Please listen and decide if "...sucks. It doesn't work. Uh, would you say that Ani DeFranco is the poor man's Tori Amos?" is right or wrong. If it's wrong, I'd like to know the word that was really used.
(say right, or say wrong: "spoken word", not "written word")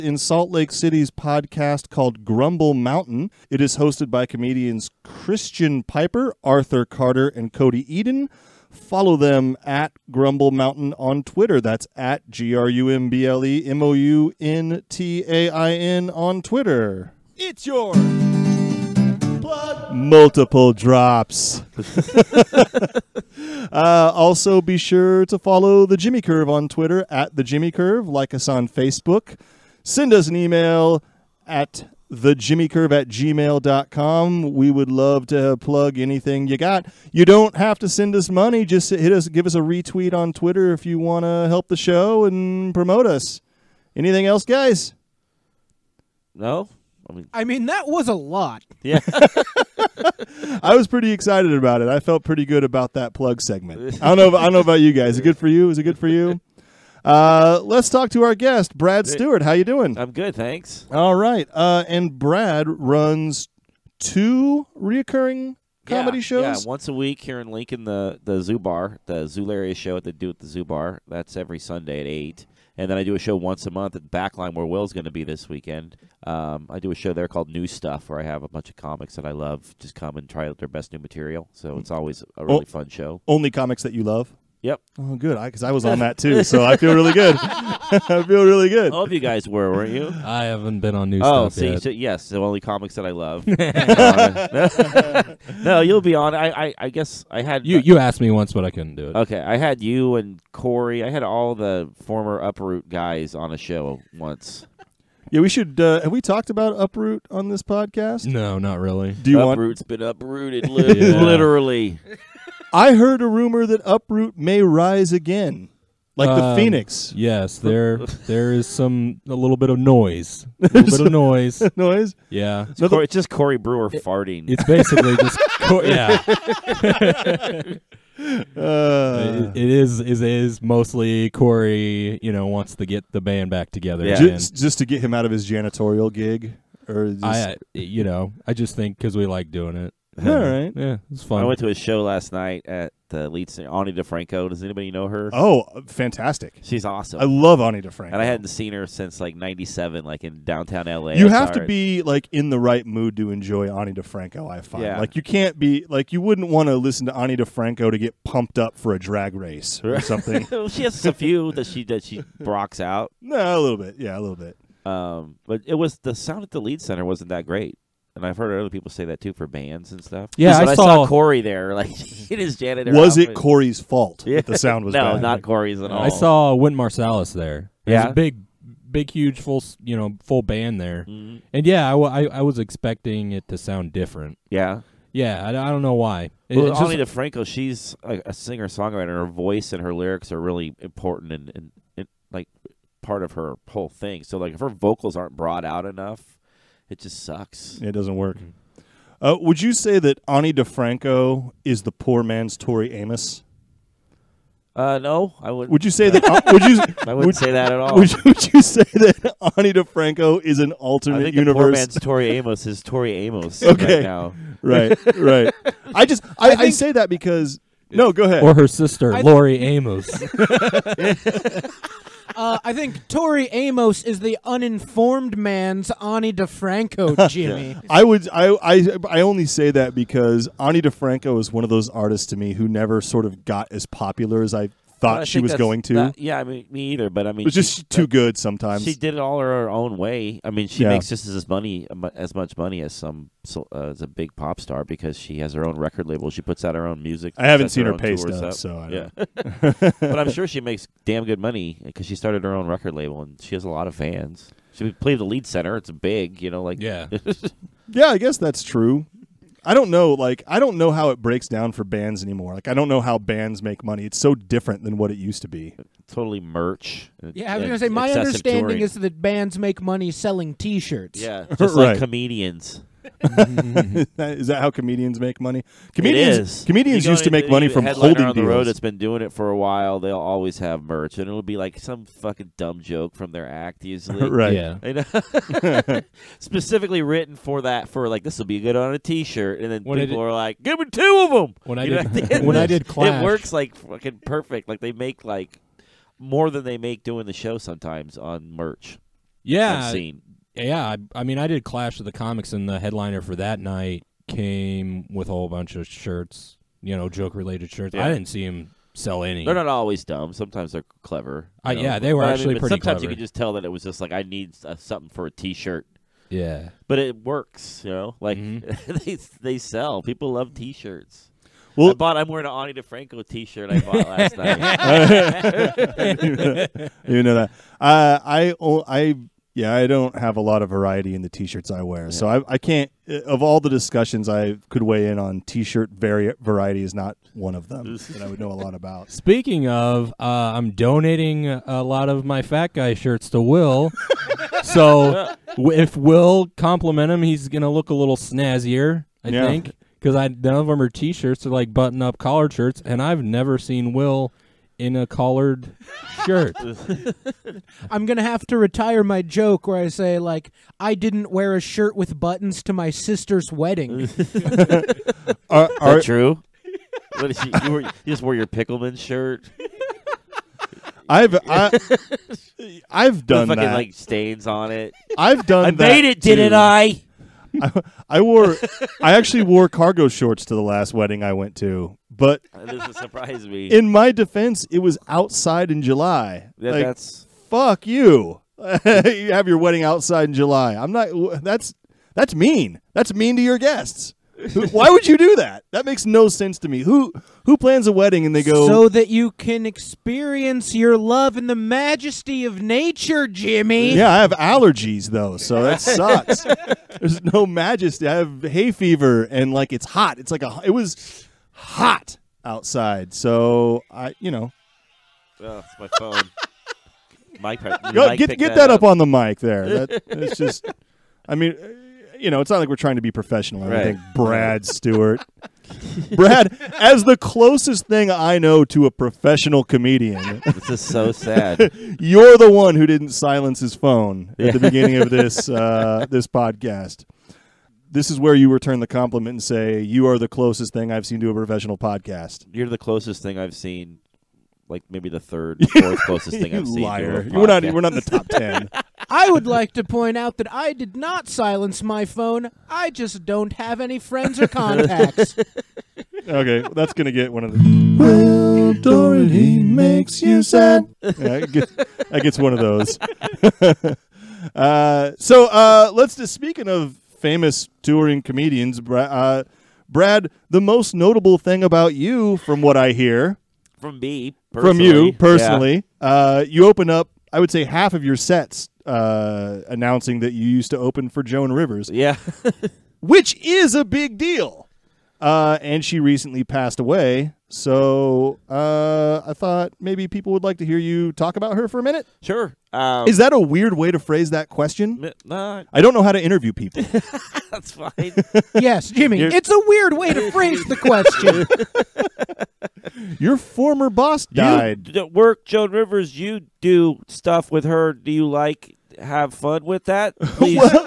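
right.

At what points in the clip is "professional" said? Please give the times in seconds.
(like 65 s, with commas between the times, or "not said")
423 s, 428 s, 441 s.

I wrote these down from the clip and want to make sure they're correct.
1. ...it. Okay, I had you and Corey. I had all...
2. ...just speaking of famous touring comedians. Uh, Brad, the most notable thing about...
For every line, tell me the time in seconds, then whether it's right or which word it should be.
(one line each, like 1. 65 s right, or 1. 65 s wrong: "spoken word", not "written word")
1. 99 s right
2. 466 s right.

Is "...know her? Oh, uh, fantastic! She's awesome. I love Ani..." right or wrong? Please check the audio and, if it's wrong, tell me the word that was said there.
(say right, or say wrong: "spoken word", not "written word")
right.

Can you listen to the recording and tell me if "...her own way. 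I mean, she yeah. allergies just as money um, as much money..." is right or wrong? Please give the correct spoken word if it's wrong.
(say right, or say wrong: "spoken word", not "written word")
wrong: "makes", not "allergies".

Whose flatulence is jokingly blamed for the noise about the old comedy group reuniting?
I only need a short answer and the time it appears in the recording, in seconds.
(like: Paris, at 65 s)
Corey Brewer, at 123 s.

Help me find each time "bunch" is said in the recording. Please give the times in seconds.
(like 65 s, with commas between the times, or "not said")
78 s, 305 s.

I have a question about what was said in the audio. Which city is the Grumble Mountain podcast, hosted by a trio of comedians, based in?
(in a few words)
Salt Lake City.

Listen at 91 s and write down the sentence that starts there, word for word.
So, yes, the only comics that I love.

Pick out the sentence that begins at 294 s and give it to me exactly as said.
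Like they make like more than they make doing the show sometimes on merch.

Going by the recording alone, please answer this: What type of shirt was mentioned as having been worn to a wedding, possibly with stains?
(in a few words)
Pickleman shirt.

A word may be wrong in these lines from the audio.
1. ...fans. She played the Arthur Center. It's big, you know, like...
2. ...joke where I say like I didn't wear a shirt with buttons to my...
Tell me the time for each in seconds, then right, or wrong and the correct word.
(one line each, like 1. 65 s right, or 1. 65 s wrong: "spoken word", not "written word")
1. 253 s wrong: "Lied", not "Arthur"
2. 359 s right.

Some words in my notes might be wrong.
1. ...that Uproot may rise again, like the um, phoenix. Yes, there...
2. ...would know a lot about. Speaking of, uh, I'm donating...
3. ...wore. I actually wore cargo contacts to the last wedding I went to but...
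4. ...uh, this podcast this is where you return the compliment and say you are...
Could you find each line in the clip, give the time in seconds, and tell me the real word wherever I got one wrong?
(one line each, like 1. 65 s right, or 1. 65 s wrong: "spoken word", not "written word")
1. 113 s right
2. 338 s right
3. 378 s wrong: "shorts", not "contacts"
4. 435 s right.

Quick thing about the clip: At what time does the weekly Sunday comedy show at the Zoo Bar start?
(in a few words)
8.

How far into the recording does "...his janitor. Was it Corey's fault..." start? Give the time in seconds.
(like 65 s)
172 s.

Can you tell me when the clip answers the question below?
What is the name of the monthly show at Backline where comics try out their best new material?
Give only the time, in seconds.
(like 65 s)
77 s.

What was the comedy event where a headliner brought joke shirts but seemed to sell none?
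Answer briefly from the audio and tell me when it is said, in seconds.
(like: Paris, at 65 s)
Clash of the Comics, at 301 s.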